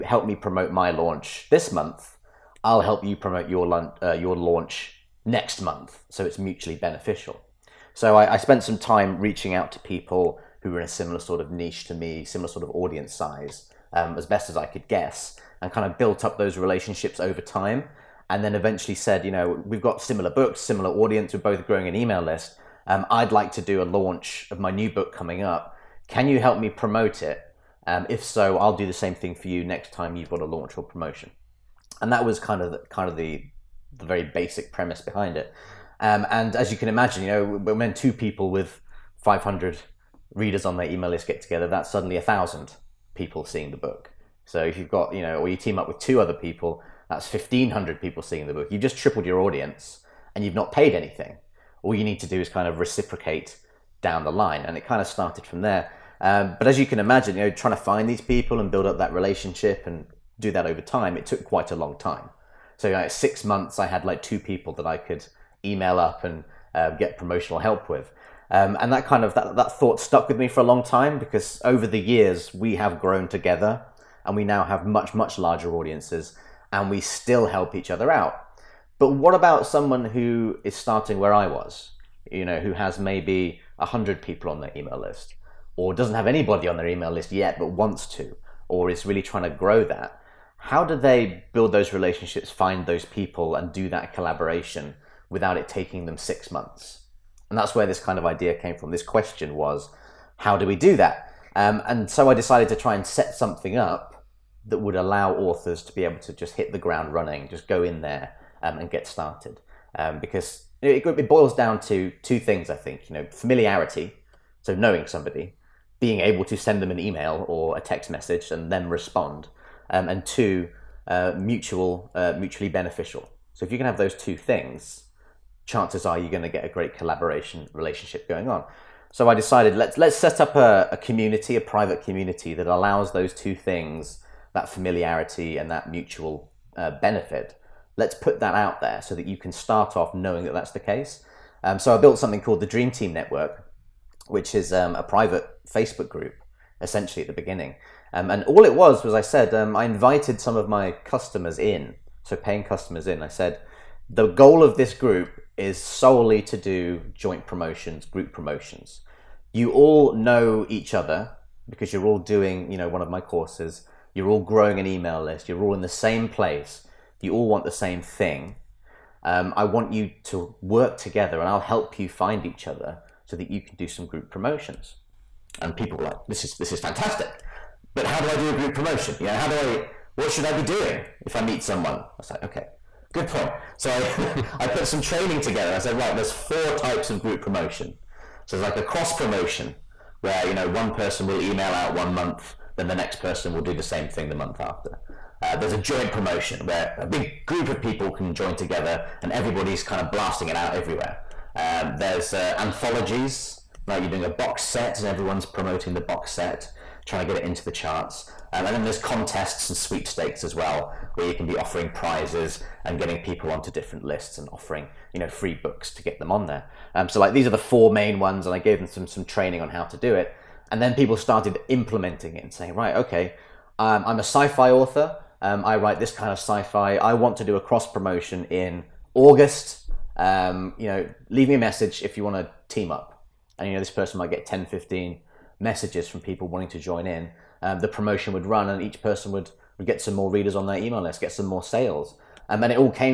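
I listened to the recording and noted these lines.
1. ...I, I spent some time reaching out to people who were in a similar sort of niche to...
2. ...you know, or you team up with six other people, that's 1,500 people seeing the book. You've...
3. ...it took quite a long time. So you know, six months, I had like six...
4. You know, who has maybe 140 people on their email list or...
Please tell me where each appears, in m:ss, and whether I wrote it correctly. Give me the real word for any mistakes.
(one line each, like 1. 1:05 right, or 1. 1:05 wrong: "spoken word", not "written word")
1. 0:08 right
2. 0:45 wrong: "two", not "six"
3. 1:01 wrong: "two", not "six"
4. 1:22 wrong: "100", not "140".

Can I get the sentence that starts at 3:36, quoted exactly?
Um, so like these are the four main ones, and I gave them some some training on how to do it.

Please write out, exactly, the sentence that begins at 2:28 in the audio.
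Um, and all it was was I said um, I invited some of my customers in, so paying customers in.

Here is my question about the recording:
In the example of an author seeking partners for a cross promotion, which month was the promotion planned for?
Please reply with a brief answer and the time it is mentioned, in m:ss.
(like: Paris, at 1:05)
August, at 3:49.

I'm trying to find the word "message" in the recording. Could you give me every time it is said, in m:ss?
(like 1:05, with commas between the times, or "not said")
1:58, 3:51, 3:55.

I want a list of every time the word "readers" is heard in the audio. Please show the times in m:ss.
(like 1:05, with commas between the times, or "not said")
0:40, 4:00.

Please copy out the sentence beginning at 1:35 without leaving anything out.
without it taking them six months.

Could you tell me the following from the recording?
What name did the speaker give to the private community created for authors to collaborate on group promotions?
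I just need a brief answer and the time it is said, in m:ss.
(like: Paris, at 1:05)
Dream Team Network, at 2:22.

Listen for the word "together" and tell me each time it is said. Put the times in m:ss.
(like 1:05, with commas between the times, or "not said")
0:41, 1:13, 2:50, 3:05, 3:18.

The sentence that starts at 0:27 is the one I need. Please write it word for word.
Um, if so, I'll do the same thing for you next time you've got a launch or promotion.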